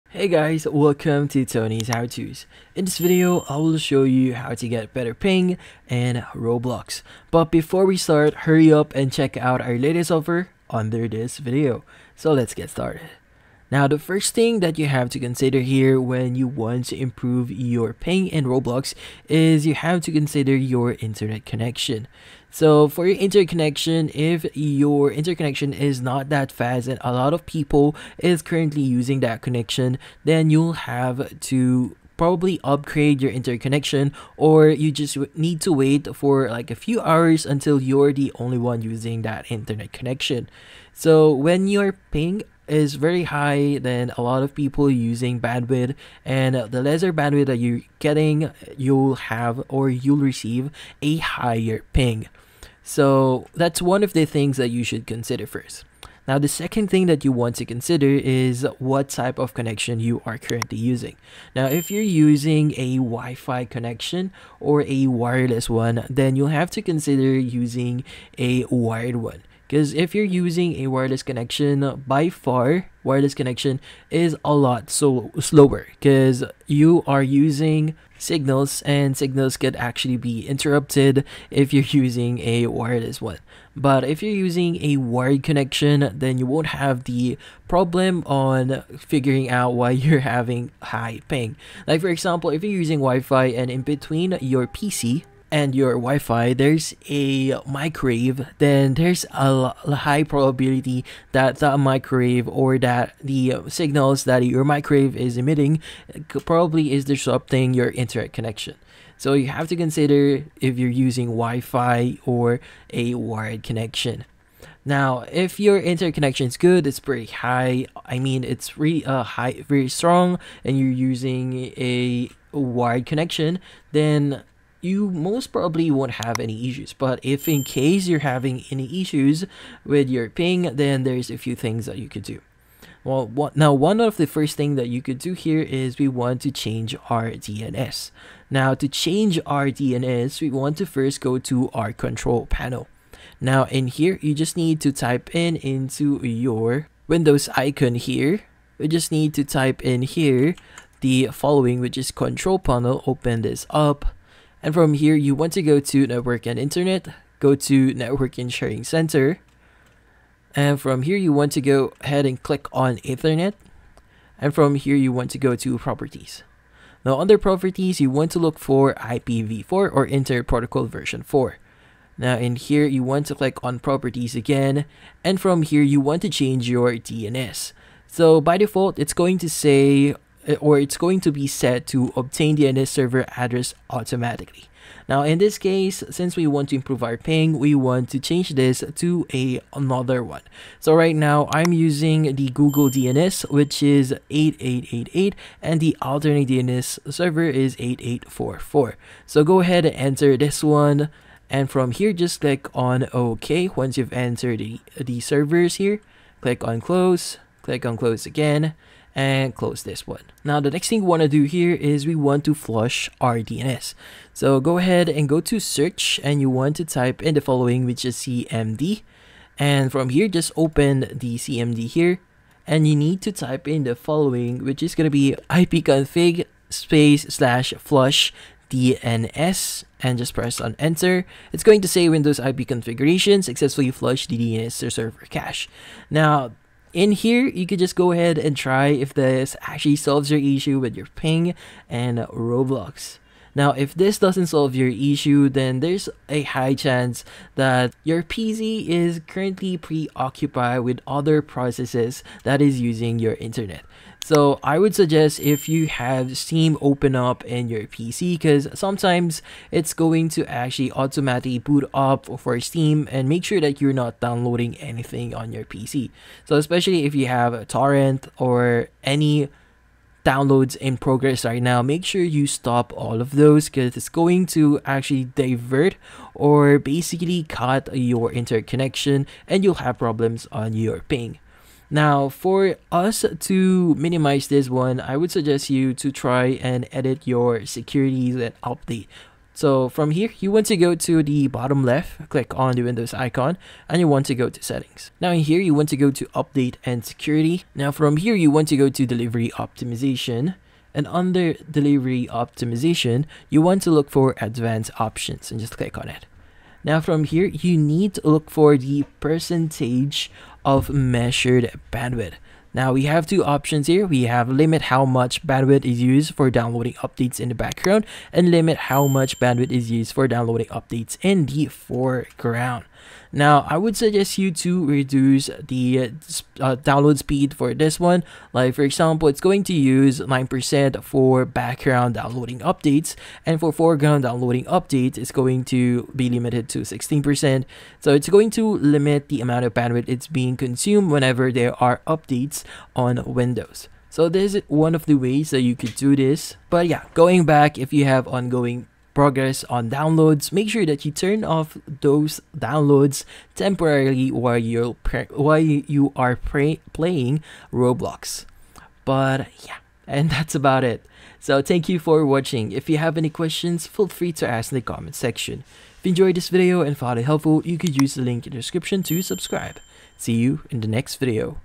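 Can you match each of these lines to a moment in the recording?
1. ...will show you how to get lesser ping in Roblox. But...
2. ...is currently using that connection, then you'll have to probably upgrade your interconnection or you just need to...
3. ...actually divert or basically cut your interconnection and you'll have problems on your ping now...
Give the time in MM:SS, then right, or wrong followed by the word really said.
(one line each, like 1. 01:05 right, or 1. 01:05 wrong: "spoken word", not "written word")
1. 00:03 wrong: "better", not "lesser"
2. 00:28 right
3. 04:34 right.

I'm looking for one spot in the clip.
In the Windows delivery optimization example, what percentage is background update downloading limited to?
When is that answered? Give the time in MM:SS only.
05:30.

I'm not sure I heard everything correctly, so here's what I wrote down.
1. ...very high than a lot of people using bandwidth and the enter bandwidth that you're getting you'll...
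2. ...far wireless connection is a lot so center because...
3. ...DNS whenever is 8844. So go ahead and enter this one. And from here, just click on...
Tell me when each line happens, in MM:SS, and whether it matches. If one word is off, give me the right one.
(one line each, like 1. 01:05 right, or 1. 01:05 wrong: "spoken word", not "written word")
1. 00:42 wrong: "lesser", not "enter"
2. 01:12 wrong: "slower", not "center"
3. 03:16 wrong: "server", not "whenever".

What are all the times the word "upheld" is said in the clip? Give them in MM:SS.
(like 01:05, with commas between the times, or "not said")
not said.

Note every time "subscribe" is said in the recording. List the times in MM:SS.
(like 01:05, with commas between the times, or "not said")
06:09.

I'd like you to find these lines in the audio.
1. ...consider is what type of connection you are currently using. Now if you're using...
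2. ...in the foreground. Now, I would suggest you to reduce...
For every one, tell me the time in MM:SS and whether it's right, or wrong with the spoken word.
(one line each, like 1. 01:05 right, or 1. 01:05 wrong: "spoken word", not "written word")
1. 00:57 right
2. 05:21 right.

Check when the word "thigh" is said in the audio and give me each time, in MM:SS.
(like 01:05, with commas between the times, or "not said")
not said.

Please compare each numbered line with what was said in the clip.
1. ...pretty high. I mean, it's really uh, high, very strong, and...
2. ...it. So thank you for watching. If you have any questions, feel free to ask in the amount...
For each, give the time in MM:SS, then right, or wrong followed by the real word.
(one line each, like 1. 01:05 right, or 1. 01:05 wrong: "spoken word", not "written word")
1. 01:56 right
2. 06:00 wrong: "comment", not "amount".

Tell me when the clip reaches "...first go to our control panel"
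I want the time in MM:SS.
02:20.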